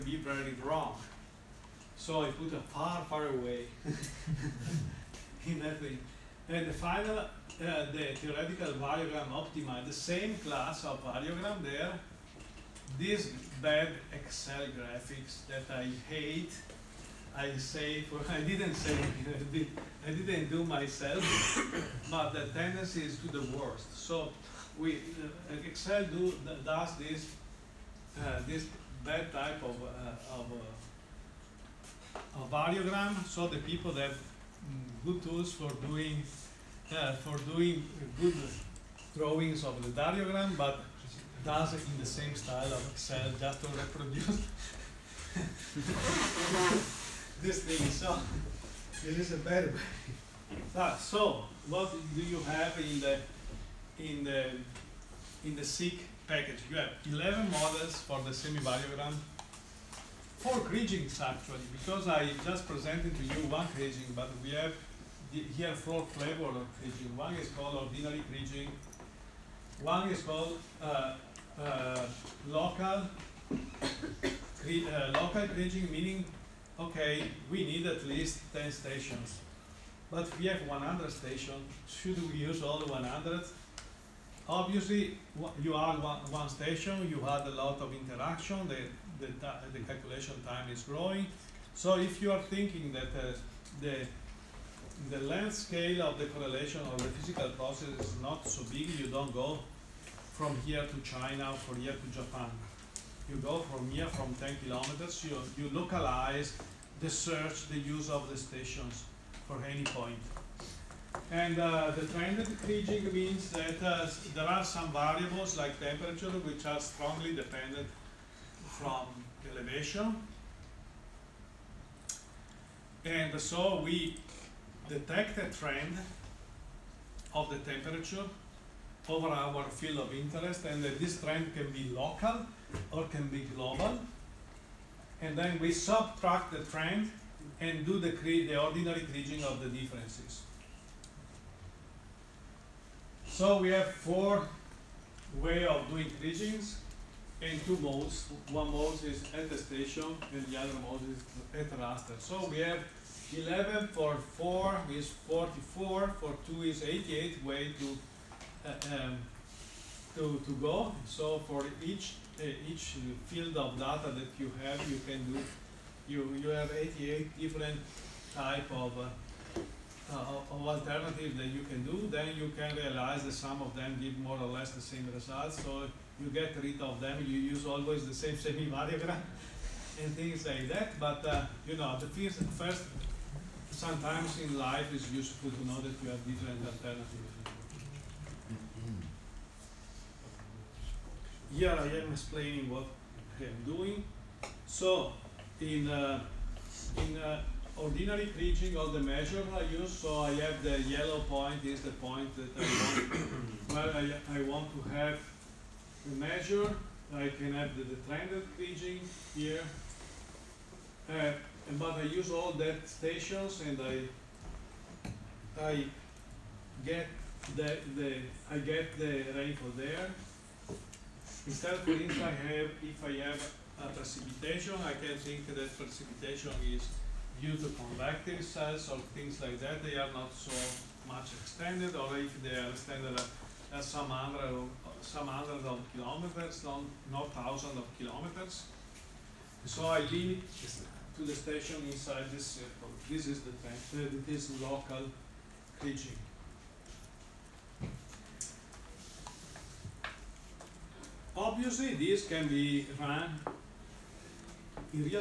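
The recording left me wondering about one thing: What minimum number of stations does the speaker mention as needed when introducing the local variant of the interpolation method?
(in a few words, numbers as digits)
10.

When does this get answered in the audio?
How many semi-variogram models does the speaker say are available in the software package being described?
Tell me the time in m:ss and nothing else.
0:57.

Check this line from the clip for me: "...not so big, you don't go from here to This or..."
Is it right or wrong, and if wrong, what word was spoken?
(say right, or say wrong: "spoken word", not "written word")
wrong: "China", not "This".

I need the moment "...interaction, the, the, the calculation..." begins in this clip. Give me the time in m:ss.
1:27.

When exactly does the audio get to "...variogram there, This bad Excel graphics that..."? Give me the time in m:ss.
0:11.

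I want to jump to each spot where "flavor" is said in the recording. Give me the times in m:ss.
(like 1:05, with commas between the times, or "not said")
1:06.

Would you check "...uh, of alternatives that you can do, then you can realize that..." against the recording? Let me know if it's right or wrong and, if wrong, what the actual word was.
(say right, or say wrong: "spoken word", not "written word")
right.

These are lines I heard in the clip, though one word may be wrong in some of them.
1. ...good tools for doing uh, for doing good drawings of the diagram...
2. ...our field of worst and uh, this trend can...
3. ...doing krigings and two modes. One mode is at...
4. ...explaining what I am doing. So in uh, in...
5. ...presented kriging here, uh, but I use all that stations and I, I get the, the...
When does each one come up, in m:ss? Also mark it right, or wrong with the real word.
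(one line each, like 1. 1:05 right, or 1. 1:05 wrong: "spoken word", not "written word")
1. 0:35 right
2. 2:09 wrong: "interest", not "worst"
3. 2:25 right
4. 3:12 right
5. 3:28 wrong: "trended", not "presented".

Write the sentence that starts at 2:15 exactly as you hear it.
And then we subtract the trend and do the, the ordinary kriging of the differences.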